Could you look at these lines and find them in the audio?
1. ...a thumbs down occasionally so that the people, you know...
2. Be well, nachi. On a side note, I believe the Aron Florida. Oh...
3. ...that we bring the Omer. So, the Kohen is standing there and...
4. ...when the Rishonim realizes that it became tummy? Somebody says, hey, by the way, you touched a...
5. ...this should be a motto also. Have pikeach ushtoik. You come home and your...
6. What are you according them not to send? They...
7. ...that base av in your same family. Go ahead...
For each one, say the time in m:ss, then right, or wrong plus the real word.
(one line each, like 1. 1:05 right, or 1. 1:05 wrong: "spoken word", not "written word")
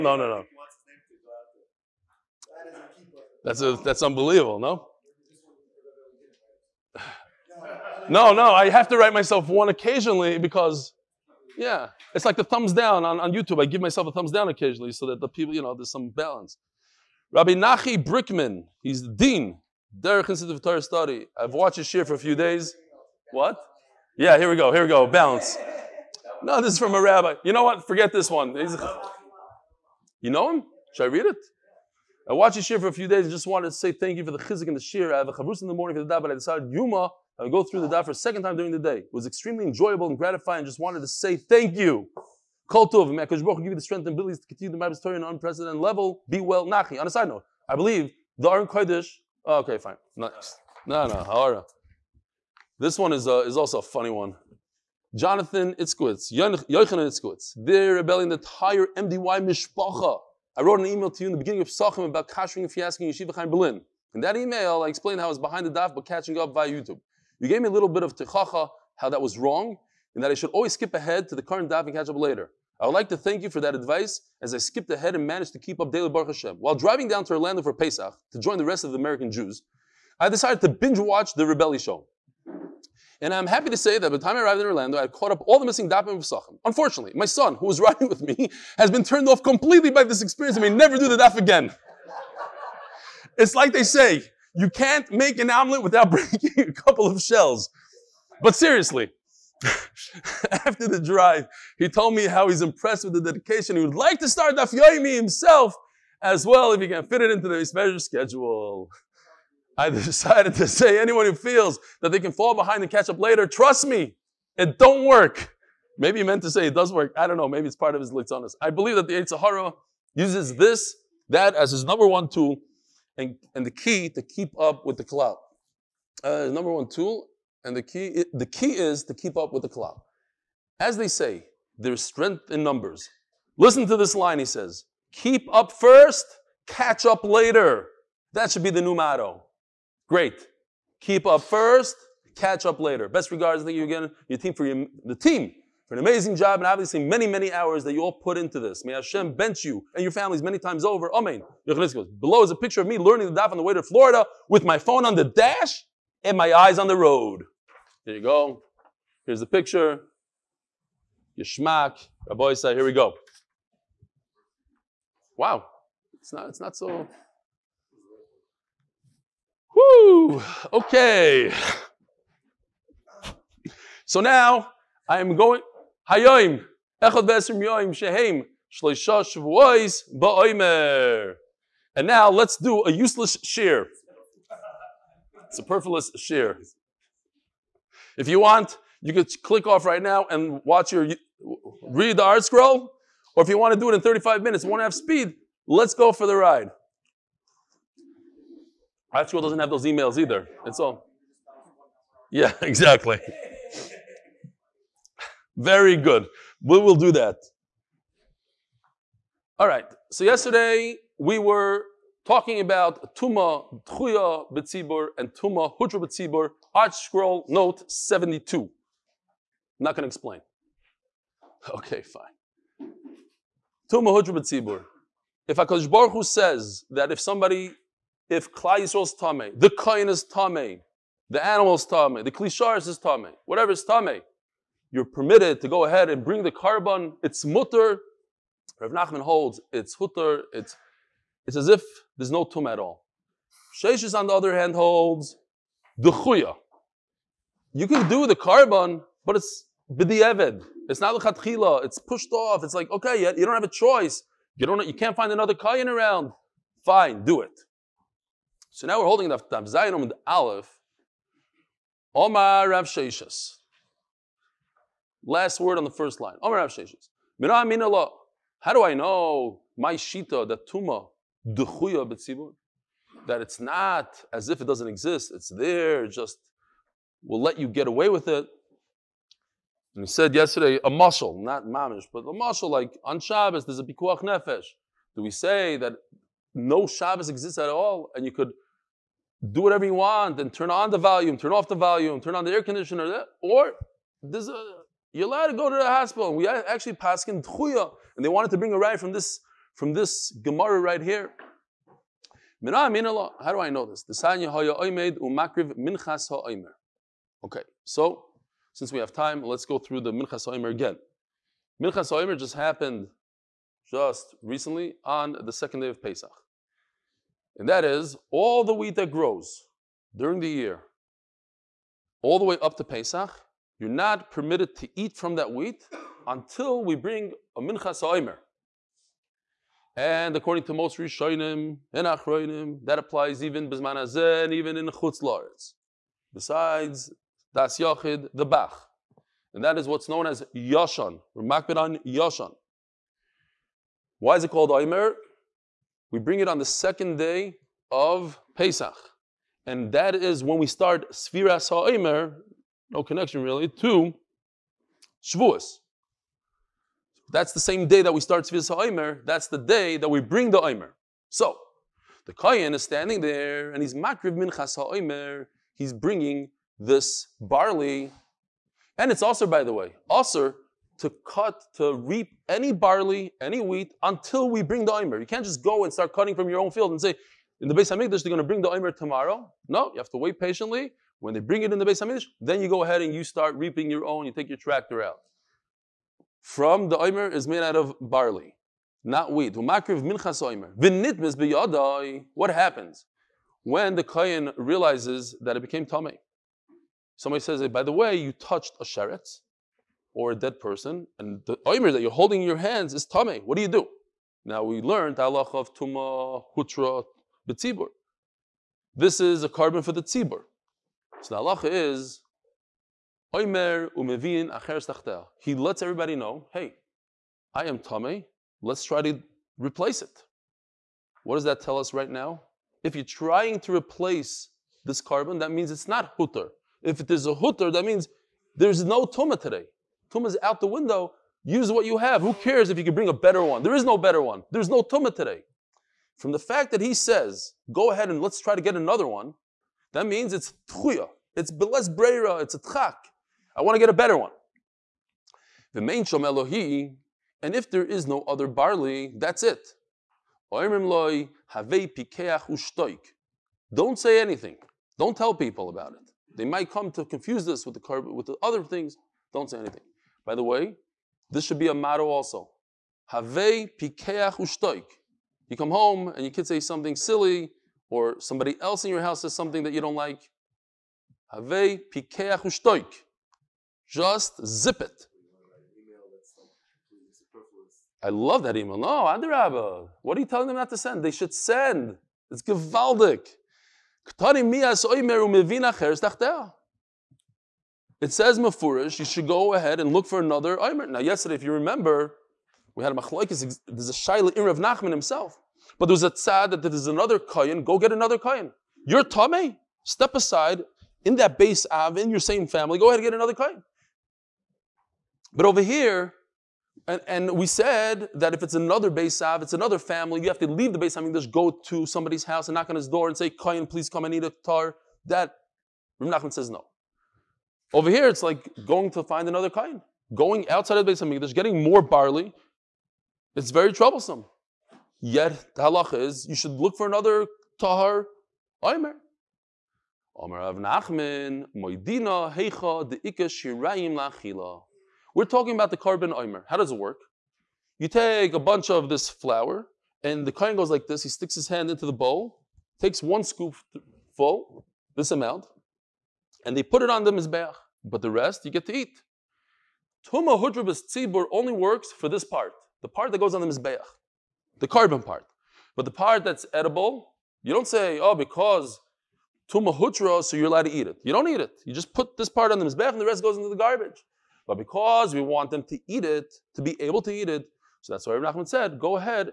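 1. 0:14 right
2. 0:46 wrong: "Kodesh", not "Florida"
3. 5:59 right
4. 6:33 wrong: "Kohen", not "Rishonim"
5. 7:41 right
6. 8:00 wrong: "telling", not "according"
7. 8:21 right.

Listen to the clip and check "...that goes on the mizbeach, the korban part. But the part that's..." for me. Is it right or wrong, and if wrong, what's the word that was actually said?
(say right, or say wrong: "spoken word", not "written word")
right.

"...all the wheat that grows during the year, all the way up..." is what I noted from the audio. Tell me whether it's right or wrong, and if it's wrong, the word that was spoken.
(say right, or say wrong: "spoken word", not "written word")
right.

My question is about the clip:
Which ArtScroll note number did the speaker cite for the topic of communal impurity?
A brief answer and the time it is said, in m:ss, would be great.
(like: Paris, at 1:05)
72, at 3:37.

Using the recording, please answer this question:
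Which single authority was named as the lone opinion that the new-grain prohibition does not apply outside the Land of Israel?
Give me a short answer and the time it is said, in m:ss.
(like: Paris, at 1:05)
The Bach, at 5:38.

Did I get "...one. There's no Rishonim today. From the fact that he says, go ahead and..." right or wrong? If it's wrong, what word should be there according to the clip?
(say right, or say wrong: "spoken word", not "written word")
wrong: "Tumah", not "Rishonim".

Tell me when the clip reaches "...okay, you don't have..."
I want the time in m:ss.
4:12.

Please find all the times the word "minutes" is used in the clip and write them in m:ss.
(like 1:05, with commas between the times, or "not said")
3:14.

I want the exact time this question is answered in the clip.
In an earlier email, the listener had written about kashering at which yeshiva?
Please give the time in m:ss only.
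1:03.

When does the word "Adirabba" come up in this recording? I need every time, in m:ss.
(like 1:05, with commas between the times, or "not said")
7:59.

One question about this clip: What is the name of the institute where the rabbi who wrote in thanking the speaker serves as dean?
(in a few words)
Derek Institute of Torah Study.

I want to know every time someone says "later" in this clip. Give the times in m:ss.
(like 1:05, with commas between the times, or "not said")
1:12, 1:53, 2:17, 2:22.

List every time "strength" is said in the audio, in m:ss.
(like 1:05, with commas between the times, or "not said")
0:43, 2:12.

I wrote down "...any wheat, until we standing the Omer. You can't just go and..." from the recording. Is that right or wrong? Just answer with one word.
wrong.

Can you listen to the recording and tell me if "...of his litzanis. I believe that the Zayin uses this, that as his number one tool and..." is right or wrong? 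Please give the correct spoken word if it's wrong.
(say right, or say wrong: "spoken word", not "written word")
wrong: "Sahara", not "Zayin".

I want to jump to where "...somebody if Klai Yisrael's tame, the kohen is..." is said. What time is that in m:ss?
3:47.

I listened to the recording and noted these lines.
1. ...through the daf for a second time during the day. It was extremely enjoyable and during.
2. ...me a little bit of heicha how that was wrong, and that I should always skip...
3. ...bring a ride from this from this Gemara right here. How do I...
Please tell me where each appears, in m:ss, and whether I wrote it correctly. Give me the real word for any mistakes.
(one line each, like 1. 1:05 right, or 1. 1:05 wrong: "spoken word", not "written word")
1. 0:37 wrong: "gratifying", not "during"
2. 1:07 wrong: "tochacha", not "heicha"
3. 4:58 right.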